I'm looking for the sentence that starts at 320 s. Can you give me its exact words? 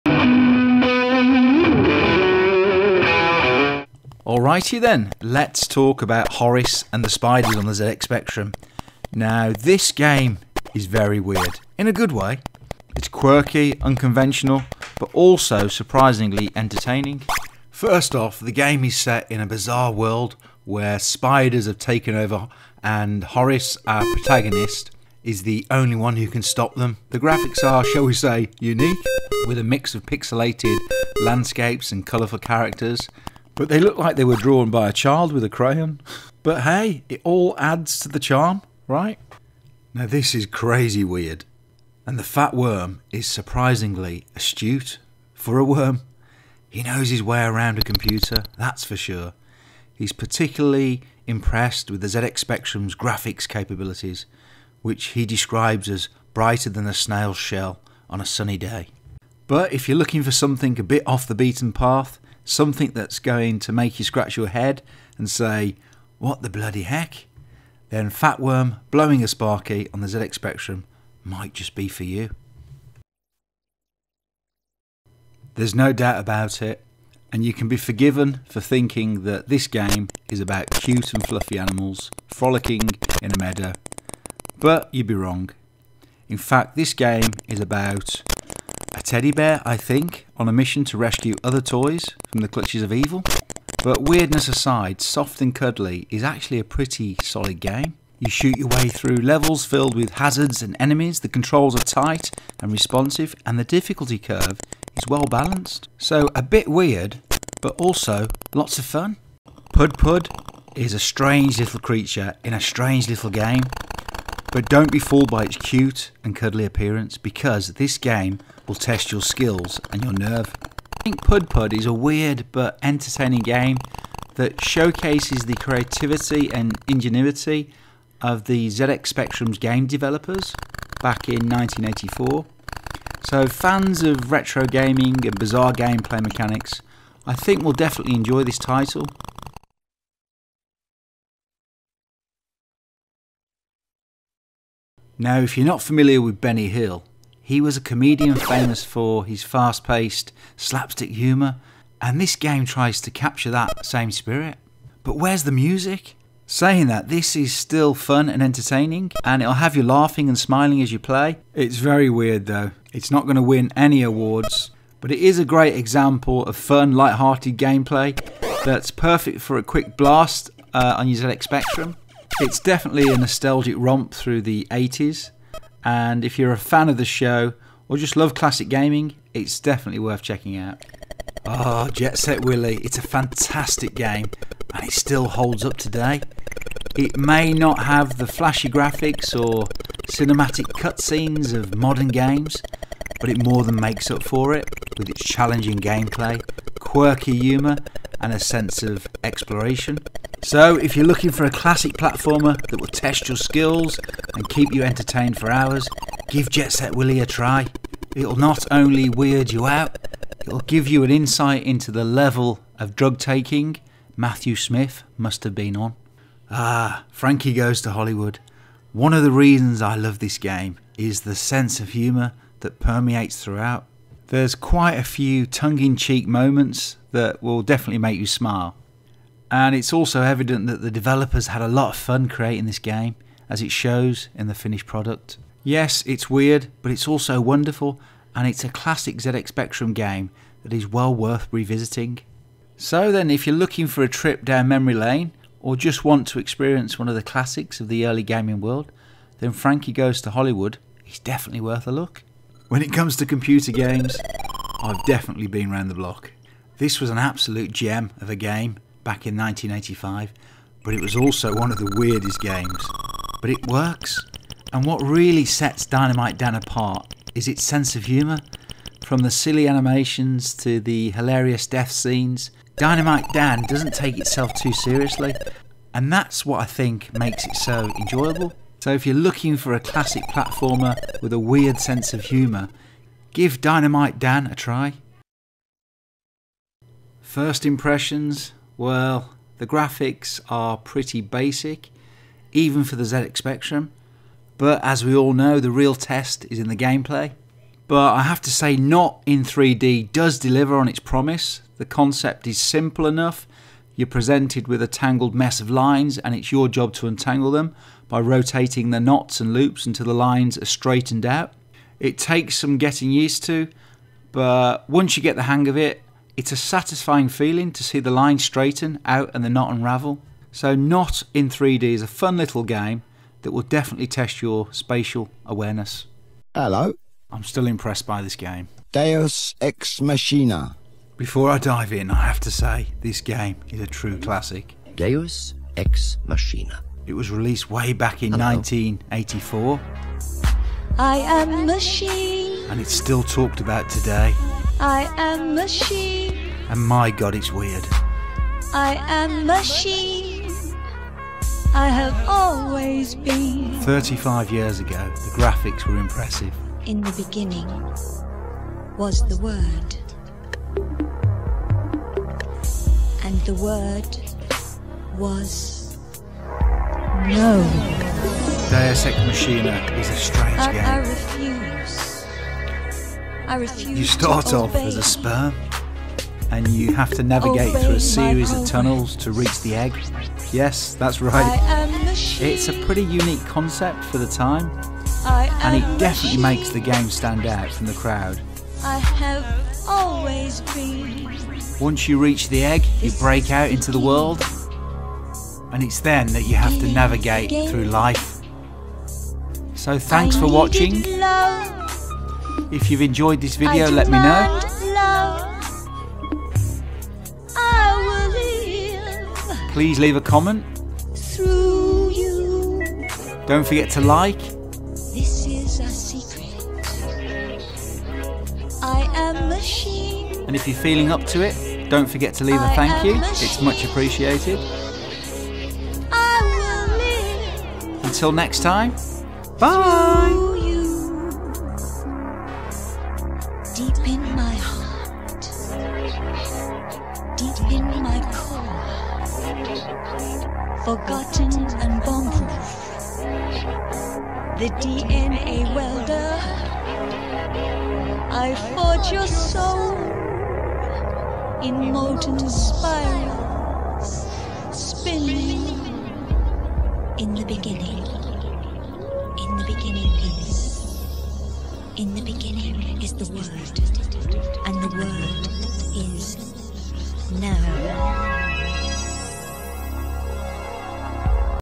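So Knot in 3D is a fun little game that will definitely test your spatial awareness.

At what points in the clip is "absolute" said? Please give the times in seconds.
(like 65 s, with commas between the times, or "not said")
257 s.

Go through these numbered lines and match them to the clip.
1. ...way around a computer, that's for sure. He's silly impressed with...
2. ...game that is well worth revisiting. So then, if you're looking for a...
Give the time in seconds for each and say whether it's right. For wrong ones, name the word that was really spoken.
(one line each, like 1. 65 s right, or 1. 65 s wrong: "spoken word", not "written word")
1. 47 s wrong: "particularly", not "silly"
2. 239 s right.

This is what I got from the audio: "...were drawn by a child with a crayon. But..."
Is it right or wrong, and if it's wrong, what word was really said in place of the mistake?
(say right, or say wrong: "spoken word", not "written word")
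right.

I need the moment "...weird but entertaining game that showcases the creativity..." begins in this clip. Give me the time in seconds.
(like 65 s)
121 s.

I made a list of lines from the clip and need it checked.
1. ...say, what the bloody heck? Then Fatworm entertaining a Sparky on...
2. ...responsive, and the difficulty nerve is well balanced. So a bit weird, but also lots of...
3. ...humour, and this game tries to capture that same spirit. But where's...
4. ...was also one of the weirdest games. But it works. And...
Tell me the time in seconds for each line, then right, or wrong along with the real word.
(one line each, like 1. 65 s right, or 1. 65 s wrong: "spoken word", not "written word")
1. 65 s wrong: "blowing", not "entertaining"
2. 102 s wrong: "curve", not "nerve"
3. 151 s right
4. 261 s right.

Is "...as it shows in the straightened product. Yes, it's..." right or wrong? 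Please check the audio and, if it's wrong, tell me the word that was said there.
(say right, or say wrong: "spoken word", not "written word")
wrong: "finished", not "straightened".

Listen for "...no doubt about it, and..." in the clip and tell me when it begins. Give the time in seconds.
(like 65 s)
75 s.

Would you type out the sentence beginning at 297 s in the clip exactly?
But I have to say, Knot in 3D does deliver on its promise.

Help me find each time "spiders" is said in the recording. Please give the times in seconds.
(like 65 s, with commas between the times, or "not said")
7 s, 20 s.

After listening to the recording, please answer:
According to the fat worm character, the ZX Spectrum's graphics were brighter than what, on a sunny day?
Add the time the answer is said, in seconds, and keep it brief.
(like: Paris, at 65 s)
a snail's shell, at 56 s.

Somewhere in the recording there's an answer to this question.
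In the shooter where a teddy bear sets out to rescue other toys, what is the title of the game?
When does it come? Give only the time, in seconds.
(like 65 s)
95 s.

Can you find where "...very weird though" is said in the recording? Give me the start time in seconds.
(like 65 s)
161 s.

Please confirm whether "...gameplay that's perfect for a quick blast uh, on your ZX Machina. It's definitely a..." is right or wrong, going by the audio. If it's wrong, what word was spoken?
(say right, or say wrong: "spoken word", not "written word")
wrong: "Spectrum", not "Machina".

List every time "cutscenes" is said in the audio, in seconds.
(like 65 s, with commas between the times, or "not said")
190 s.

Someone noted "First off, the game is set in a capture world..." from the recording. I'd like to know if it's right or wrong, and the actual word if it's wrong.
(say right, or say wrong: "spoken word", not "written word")
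wrong: "bizarre", not "capture".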